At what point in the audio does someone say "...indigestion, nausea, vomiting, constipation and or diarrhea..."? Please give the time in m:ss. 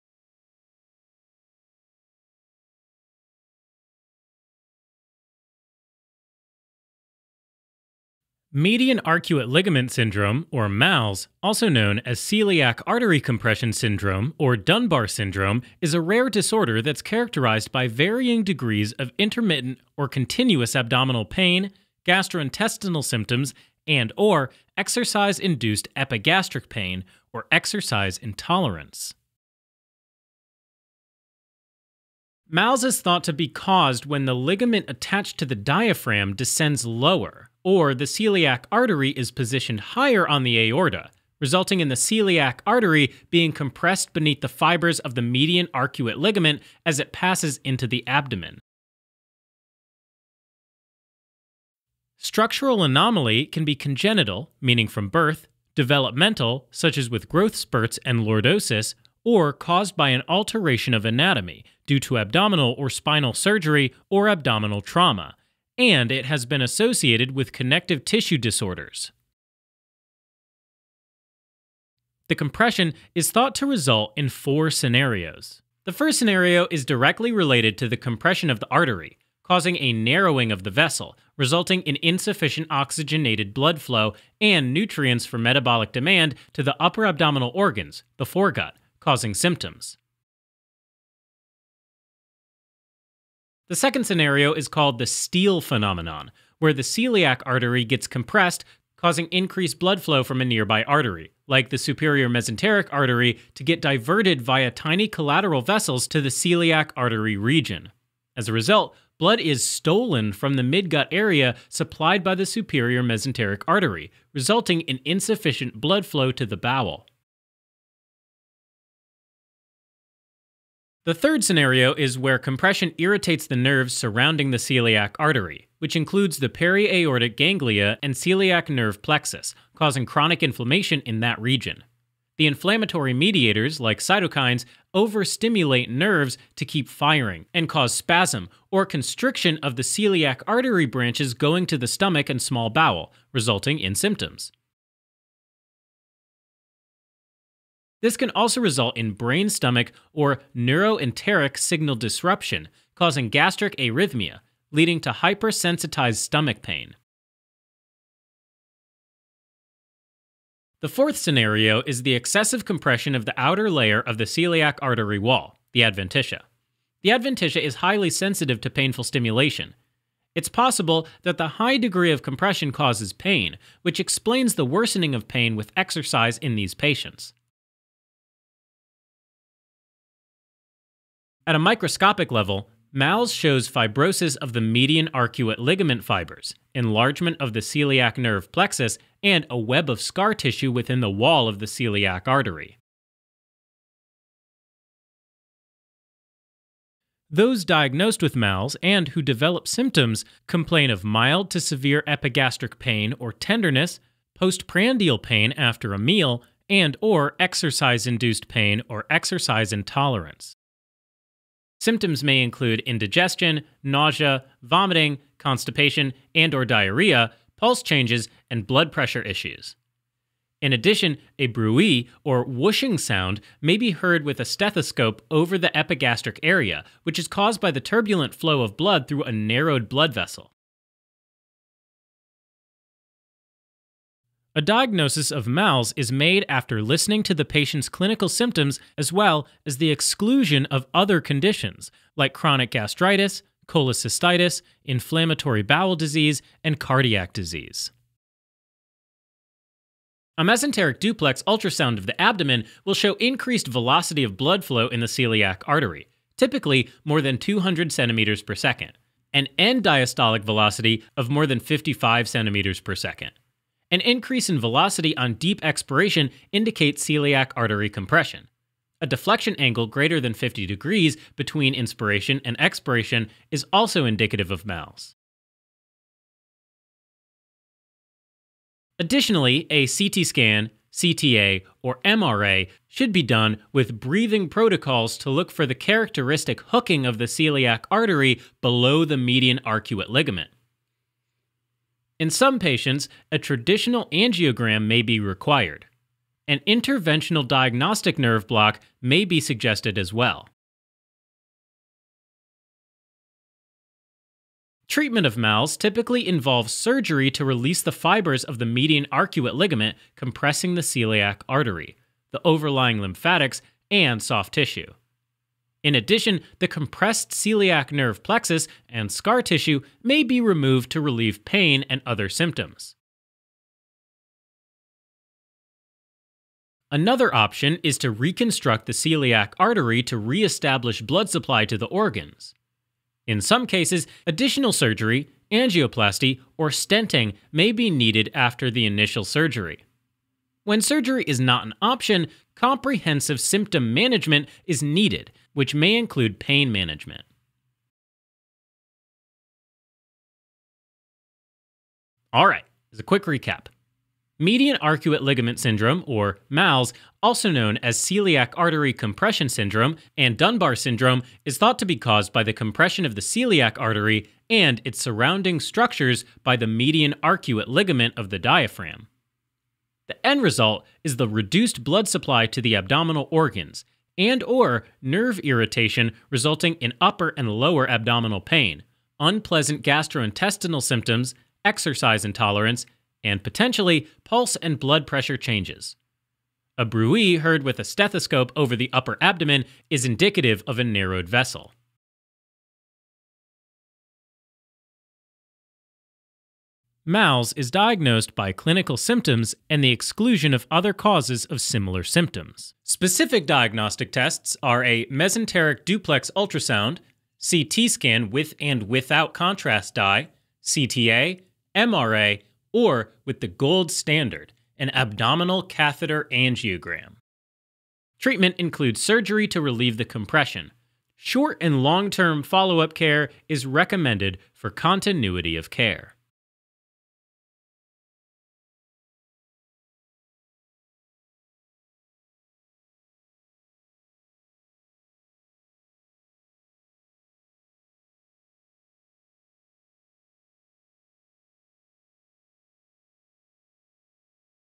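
3:32.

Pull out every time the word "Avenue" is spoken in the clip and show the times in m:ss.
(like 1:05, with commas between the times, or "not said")
not said.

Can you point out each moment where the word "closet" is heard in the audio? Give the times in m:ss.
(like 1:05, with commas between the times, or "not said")
not said.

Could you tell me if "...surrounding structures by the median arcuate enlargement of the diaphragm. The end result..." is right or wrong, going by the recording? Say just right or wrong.
wrong.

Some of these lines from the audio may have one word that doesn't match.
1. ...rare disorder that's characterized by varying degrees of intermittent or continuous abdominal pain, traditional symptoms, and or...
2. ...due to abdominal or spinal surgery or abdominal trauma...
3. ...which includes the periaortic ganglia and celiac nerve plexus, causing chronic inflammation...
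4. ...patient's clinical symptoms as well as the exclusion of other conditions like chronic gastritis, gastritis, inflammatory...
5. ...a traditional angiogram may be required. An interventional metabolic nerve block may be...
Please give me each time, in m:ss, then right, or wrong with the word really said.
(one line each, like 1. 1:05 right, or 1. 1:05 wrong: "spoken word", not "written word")
1. 0:16 wrong: "gastrointestinal", not "traditional"
2. 1:01 right
3. 2:05 right
4. 3:57 wrong: "cholecystitis", not "gastritis"
5. 4:53 wrong: "diagnostic", not "metabolic".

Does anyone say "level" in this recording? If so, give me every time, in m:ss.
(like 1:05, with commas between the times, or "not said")
3:02.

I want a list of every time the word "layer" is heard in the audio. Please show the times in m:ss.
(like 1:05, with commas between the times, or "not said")
2:43.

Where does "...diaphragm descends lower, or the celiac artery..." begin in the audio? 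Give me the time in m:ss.
0:35.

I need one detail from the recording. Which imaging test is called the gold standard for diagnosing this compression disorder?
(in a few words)
abdominal catheter angiogram.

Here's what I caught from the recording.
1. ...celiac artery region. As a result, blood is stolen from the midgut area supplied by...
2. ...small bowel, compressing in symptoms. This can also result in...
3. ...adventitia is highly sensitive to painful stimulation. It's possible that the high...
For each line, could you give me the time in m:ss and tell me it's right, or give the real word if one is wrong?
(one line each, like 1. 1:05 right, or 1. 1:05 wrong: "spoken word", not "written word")
1. 1:46 right
2. 2:22 wrong: "resulting", not "compressing"
3. 2:47 right.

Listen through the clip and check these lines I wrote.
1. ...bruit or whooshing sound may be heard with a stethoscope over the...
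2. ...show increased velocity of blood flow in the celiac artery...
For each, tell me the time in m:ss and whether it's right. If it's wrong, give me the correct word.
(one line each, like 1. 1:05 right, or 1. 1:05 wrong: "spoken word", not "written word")
1. 3:41 right
2. 4:12 right.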